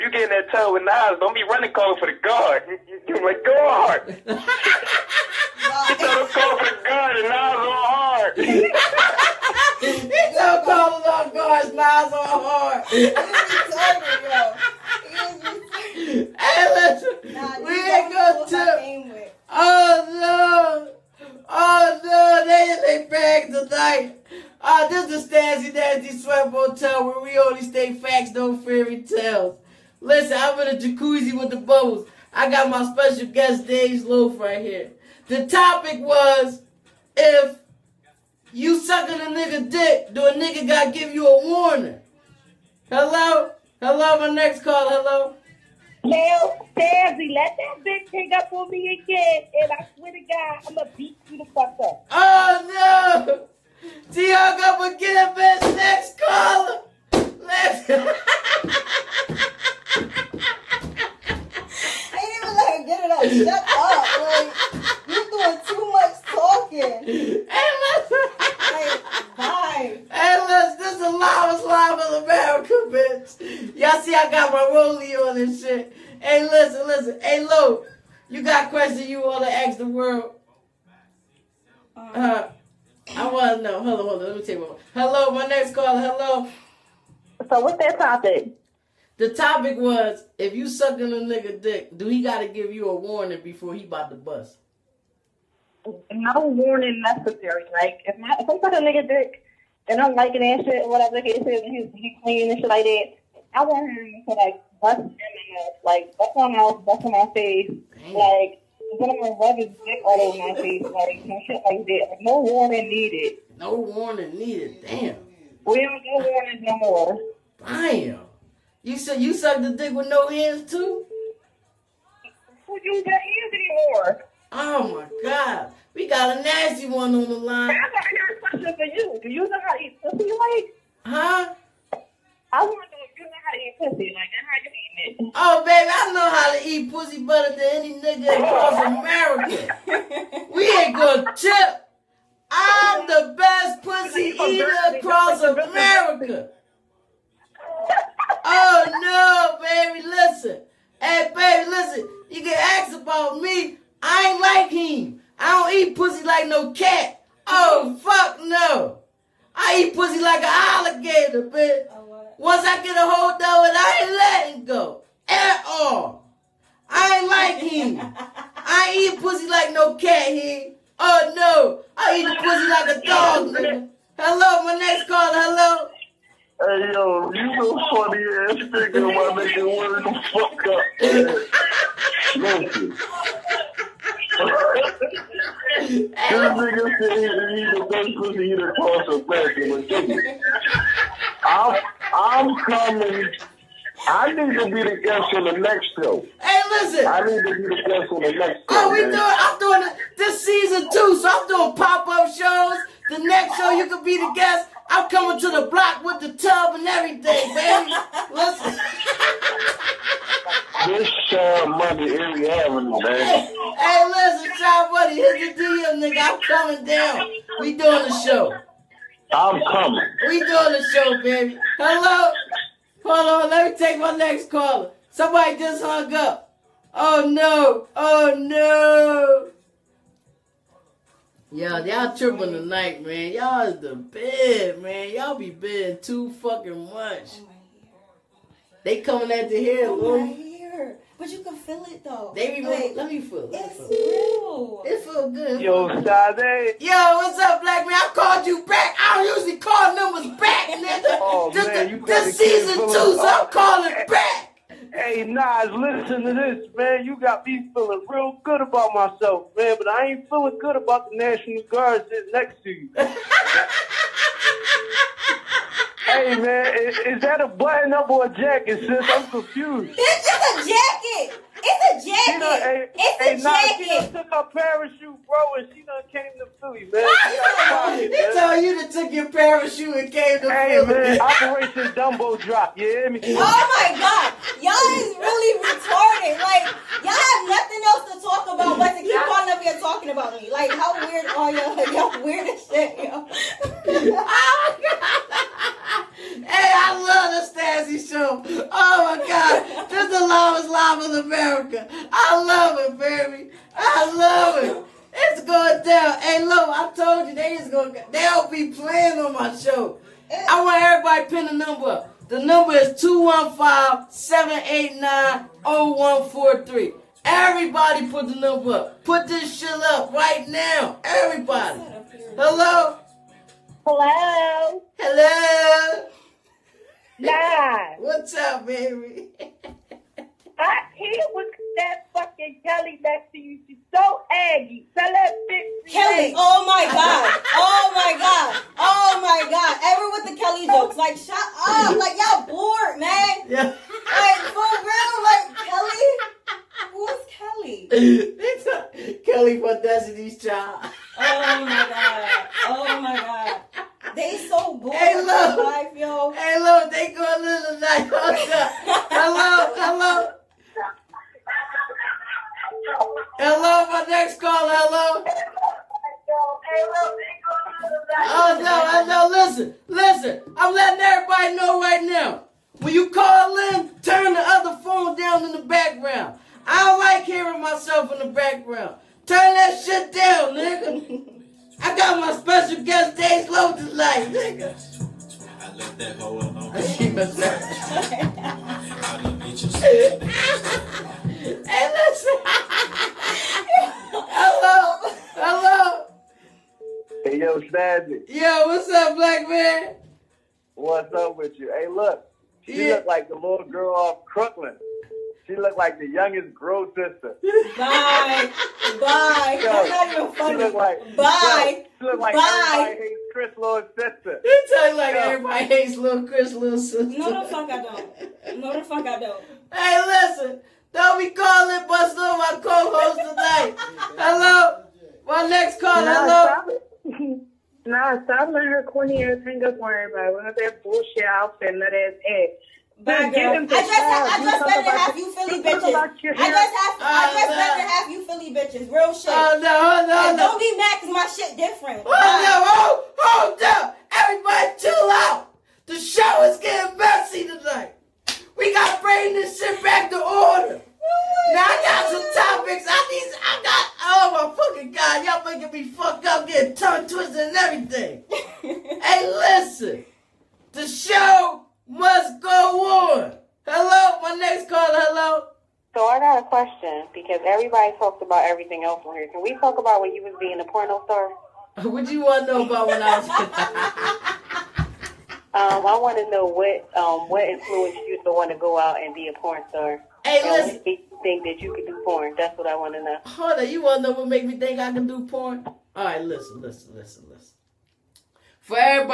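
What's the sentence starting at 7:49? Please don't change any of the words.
Can we talk about when you was being a porno star?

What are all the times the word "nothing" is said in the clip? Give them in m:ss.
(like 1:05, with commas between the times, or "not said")
4:47.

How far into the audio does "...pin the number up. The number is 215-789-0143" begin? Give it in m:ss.
5:11.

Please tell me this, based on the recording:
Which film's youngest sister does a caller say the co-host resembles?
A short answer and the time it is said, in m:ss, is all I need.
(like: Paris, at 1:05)
Crooklyn, at 6:44.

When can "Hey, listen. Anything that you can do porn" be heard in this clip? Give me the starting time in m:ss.
8:00.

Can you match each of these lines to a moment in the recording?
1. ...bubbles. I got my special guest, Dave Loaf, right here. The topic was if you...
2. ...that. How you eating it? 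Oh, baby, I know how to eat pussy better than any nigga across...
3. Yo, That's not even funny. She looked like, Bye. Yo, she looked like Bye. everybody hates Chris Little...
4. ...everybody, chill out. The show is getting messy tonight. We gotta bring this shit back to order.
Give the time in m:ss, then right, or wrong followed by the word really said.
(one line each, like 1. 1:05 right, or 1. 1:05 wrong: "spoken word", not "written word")
1. 0:31 right
2. 2:14 right
3. 6:49 right
4. 7:24 right.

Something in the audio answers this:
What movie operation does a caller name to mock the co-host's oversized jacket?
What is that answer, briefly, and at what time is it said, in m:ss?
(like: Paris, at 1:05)
Operation Dumbo Drop, at 4:41.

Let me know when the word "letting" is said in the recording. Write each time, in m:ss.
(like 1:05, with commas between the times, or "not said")
2:44, 6:10, 7:08.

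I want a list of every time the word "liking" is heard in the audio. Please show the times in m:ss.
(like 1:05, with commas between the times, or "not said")
1:40.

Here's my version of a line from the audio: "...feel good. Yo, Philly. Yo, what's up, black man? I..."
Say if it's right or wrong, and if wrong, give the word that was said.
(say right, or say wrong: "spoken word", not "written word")
wrong: "Sade", not "Philly".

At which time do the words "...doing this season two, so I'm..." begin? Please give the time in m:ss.
3:19.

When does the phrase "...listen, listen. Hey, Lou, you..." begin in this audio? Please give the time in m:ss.
1:16.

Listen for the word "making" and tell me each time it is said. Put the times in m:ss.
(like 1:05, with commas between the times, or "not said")
7:35.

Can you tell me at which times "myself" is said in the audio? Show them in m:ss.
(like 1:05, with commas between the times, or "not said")
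4:18, 6:17.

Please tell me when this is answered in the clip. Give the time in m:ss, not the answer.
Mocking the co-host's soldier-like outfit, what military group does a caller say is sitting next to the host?
4:21.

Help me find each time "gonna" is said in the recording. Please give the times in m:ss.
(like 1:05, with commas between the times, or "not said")
0:50, 2:20.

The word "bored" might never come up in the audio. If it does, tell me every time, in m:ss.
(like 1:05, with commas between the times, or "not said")
5:42, 5:54.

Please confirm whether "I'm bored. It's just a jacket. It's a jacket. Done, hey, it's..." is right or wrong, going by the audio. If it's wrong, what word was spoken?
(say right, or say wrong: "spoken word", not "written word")
wrong: "confused", not "bored".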